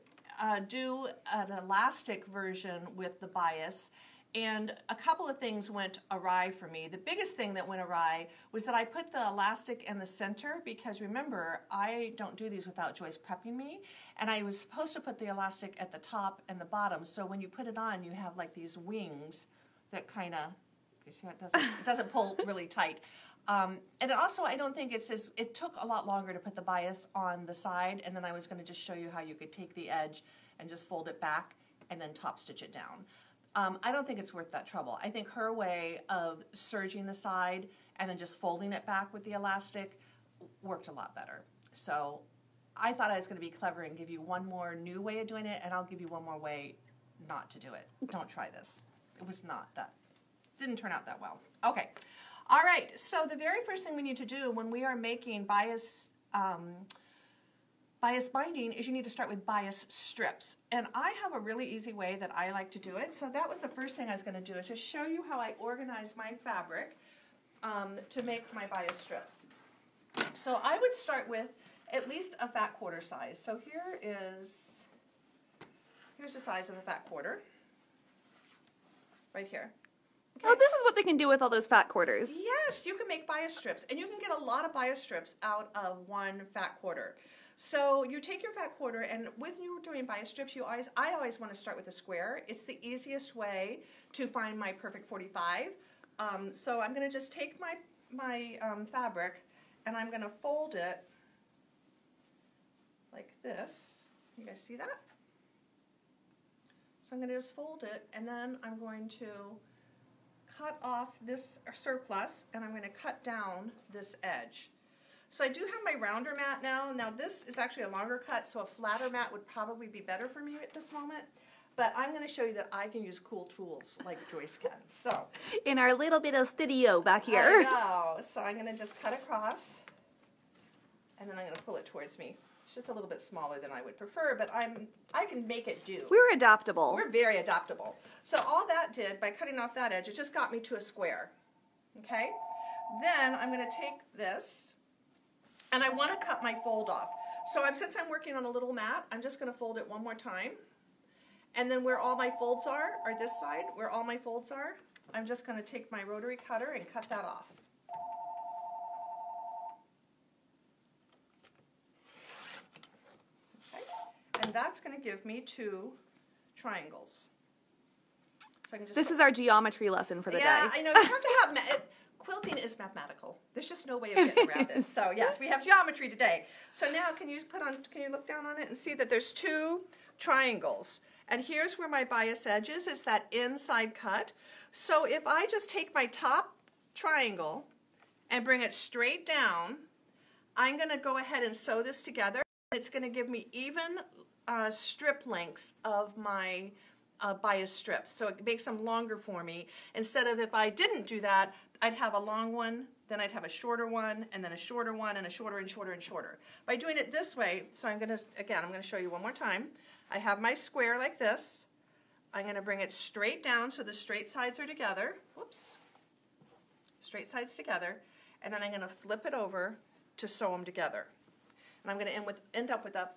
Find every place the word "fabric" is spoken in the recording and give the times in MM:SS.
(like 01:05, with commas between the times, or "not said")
01:06, 01:38.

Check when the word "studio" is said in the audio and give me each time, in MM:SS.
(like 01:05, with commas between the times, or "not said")
02:06.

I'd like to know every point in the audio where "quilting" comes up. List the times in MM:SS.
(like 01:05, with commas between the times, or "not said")
02:52.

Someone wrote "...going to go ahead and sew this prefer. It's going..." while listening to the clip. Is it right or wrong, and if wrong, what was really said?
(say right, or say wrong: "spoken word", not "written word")
wrong: "together", not "prefer".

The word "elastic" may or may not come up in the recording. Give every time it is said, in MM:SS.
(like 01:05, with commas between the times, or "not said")
00:01, 00:09, 00:15, 00:39.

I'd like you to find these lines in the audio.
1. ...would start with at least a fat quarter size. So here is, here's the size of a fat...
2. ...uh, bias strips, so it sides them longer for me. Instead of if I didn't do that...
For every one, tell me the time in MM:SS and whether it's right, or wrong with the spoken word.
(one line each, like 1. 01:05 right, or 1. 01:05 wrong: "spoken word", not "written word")
1. 01:10 right
2. 03:17 wrong: "makes", not "sides".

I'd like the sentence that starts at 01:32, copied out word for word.
It's the easiest way to find my perfect 45.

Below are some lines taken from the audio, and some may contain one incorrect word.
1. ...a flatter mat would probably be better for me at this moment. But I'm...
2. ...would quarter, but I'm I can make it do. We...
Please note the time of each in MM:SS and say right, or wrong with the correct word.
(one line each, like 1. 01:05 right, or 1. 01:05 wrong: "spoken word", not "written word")
1. 01:58 right
2. 02:13 wrong: "prefer", not "quarter".